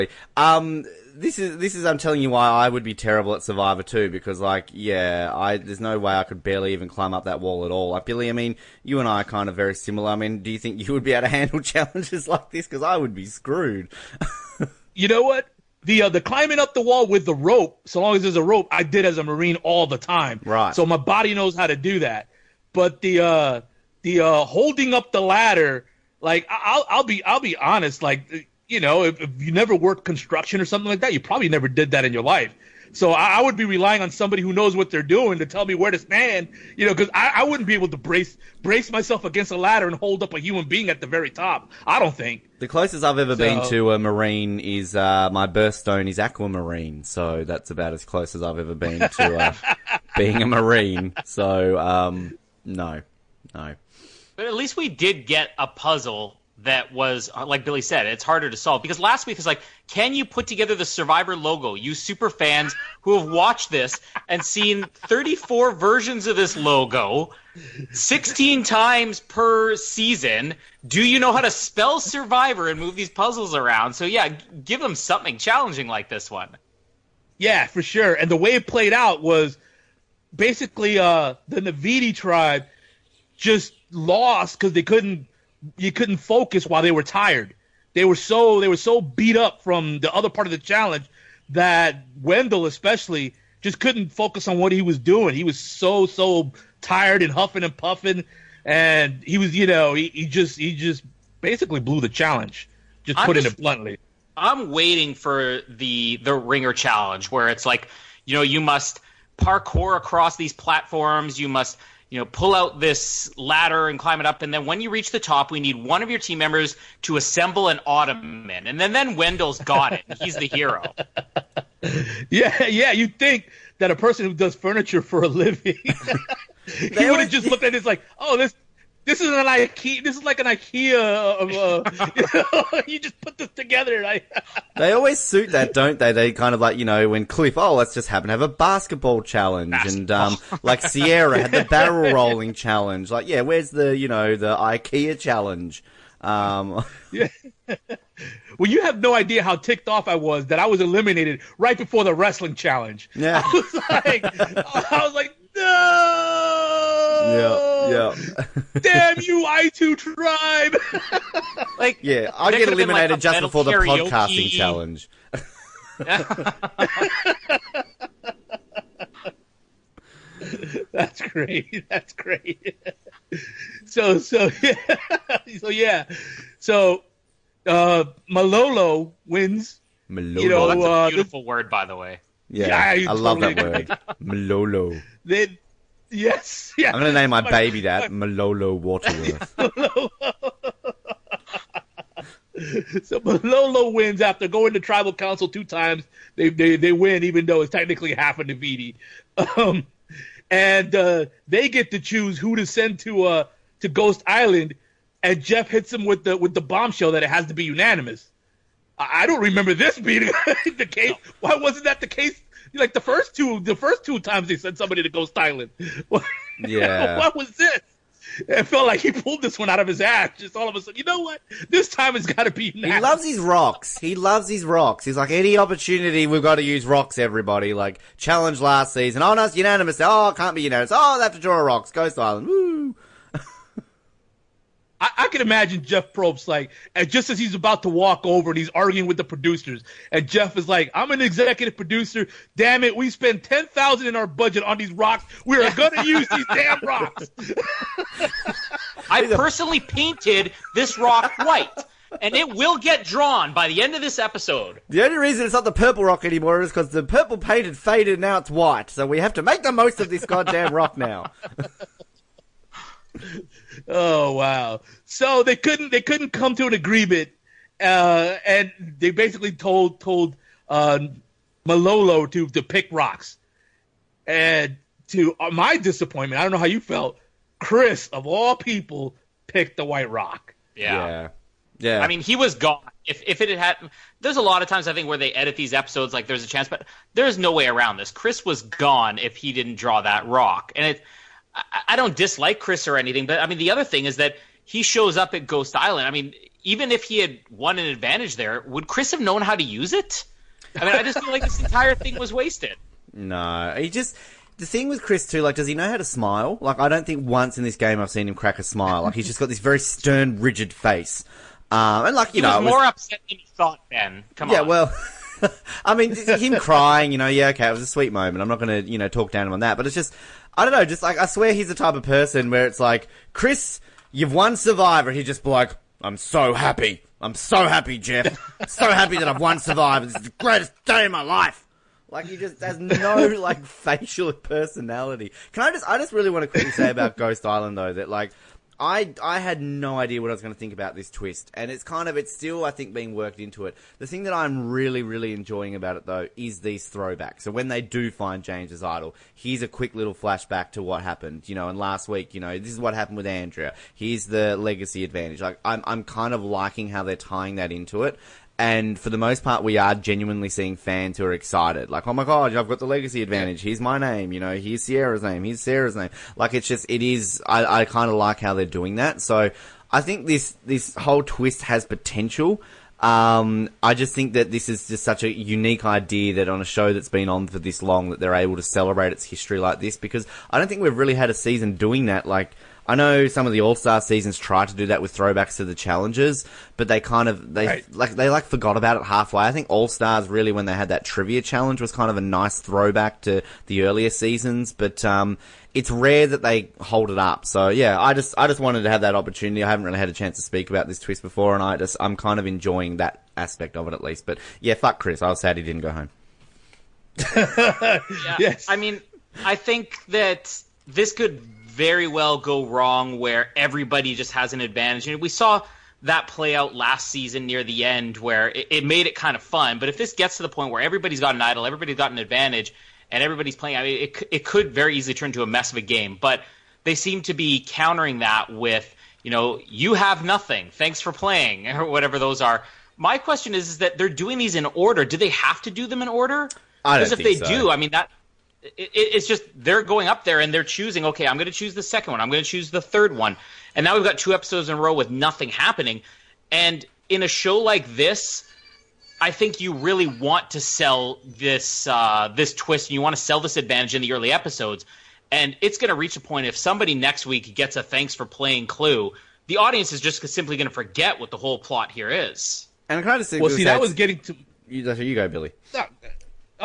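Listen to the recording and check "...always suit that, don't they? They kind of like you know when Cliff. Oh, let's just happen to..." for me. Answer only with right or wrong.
right.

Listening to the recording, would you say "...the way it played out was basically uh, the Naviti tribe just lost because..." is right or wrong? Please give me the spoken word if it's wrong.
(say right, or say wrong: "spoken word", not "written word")
right.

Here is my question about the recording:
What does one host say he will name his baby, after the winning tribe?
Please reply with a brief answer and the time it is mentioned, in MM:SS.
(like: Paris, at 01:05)
Malolo Waterworth, at 03:08.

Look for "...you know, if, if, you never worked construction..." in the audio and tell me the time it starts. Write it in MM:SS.
00:28.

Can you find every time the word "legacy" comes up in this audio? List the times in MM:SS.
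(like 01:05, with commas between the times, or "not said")
05:54, 06:02.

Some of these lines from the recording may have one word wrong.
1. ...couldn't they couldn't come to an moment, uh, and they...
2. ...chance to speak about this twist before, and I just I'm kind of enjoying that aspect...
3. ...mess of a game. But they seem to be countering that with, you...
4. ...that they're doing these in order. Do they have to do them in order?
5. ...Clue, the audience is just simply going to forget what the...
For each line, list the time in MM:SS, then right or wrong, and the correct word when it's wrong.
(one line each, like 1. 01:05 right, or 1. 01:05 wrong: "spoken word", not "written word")
1. 04:25 wrong: "agreement", not "moment"
2. 06:40 right
3. 07:05 right
4. 07:13 right
5. 07:38 right.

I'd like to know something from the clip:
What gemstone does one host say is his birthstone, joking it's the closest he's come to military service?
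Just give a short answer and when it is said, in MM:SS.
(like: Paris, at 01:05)
Aquamarine, at 00:46.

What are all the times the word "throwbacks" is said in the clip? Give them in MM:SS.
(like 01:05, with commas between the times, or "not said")
05:46, 06:25, 06:32.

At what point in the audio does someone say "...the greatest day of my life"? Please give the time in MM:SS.
05:30.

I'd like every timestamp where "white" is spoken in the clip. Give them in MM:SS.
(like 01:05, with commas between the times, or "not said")
04:11, 04:18, 04:39.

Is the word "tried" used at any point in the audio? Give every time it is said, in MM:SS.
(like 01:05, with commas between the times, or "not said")
06:24.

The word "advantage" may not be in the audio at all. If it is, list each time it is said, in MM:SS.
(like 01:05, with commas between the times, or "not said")
04:57, 05:55, 06:03, 06:54, 07:02, 07:33.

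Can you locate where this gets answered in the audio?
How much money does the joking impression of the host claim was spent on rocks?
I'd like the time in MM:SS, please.
04:03.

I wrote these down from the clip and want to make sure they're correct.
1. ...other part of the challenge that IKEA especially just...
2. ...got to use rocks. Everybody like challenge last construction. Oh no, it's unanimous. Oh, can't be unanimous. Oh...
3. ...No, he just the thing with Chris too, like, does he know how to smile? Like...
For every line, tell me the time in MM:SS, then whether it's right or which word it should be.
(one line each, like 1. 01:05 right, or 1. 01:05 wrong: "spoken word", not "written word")
1. 01:30 wrong: "Wendell", not "IKEA"
2. 03:46 wrong: "season", not "construction"
3. 05:03 right.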